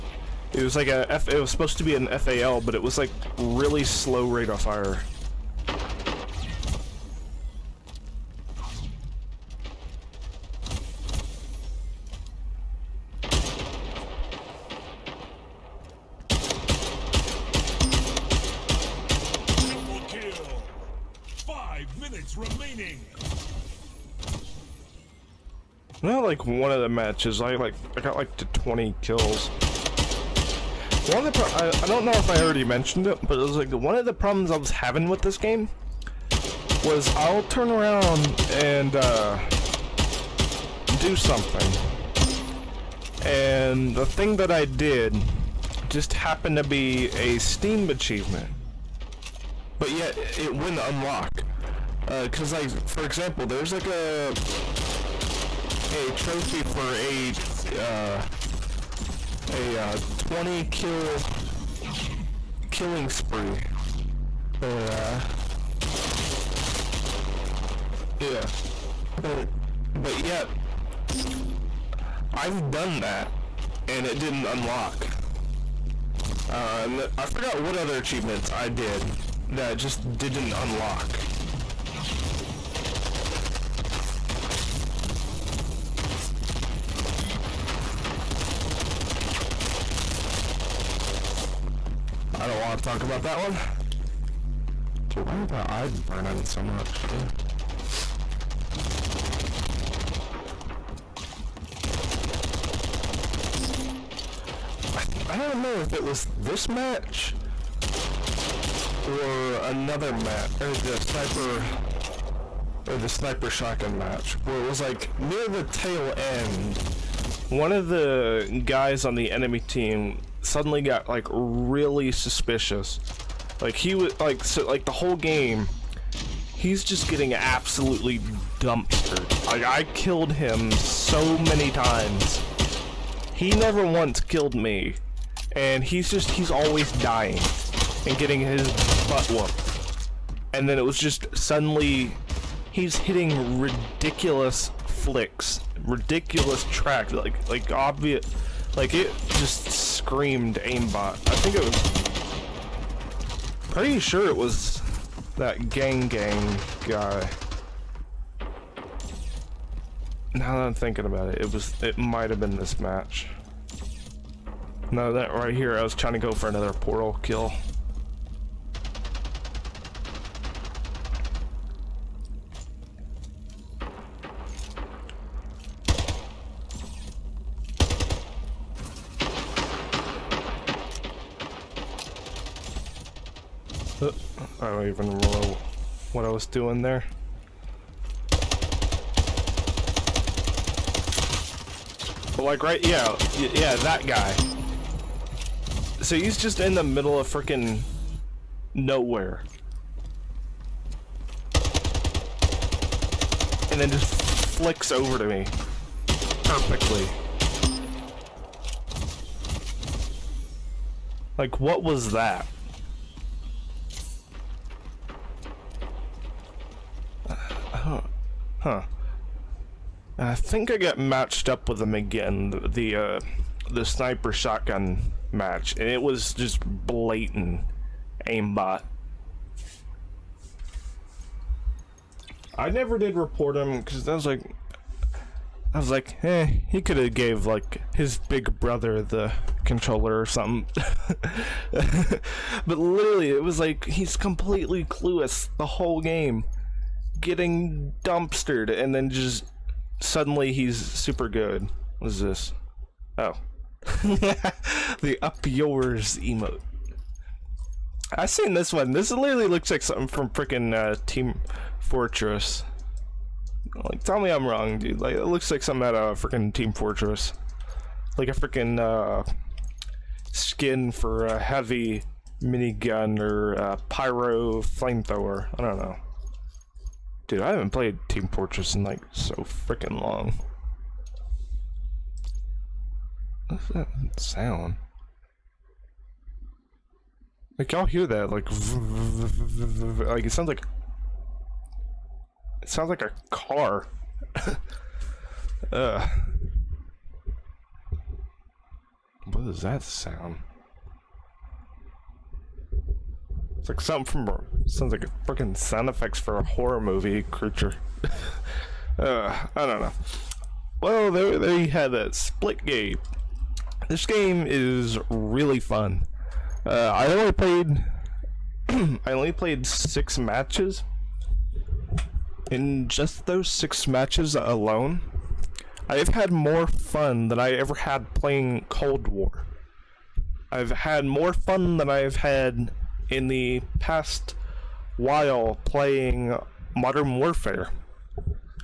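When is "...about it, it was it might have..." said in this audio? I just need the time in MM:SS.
02:41.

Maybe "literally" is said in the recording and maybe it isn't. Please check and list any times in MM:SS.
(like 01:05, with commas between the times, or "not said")
04:02, 04:19.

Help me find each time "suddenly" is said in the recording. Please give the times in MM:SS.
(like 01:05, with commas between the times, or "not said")
02:00, 02:21, 04:10.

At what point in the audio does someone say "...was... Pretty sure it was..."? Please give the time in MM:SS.
02:31.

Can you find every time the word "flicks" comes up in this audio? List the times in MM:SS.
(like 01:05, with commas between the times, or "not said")
02:24, 03:24.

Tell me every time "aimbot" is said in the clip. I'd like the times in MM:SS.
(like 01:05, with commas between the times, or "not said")
02:30, 03:48.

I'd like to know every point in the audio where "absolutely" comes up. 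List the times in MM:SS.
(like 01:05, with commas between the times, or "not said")
02:07.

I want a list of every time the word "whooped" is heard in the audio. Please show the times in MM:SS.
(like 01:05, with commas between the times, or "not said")
02:19.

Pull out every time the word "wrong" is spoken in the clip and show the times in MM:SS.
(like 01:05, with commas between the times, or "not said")
04:24.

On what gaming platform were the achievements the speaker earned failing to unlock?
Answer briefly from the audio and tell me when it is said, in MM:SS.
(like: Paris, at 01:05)
Steam, at 00:47.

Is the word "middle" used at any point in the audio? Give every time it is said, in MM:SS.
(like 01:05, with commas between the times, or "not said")
03:16.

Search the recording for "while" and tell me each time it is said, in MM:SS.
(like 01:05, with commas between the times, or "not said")
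05:34.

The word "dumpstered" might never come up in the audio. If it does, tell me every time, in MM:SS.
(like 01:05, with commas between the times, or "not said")
02:08, 04:08.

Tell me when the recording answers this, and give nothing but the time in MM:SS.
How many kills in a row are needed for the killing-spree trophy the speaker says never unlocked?
01:00.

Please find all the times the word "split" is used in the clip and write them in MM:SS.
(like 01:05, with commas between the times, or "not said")
05:12.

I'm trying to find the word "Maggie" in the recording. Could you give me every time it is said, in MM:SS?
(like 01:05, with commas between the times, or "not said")
not said.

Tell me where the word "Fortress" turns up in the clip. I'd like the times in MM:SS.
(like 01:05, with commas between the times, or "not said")
04:21, 04:26, 04:38.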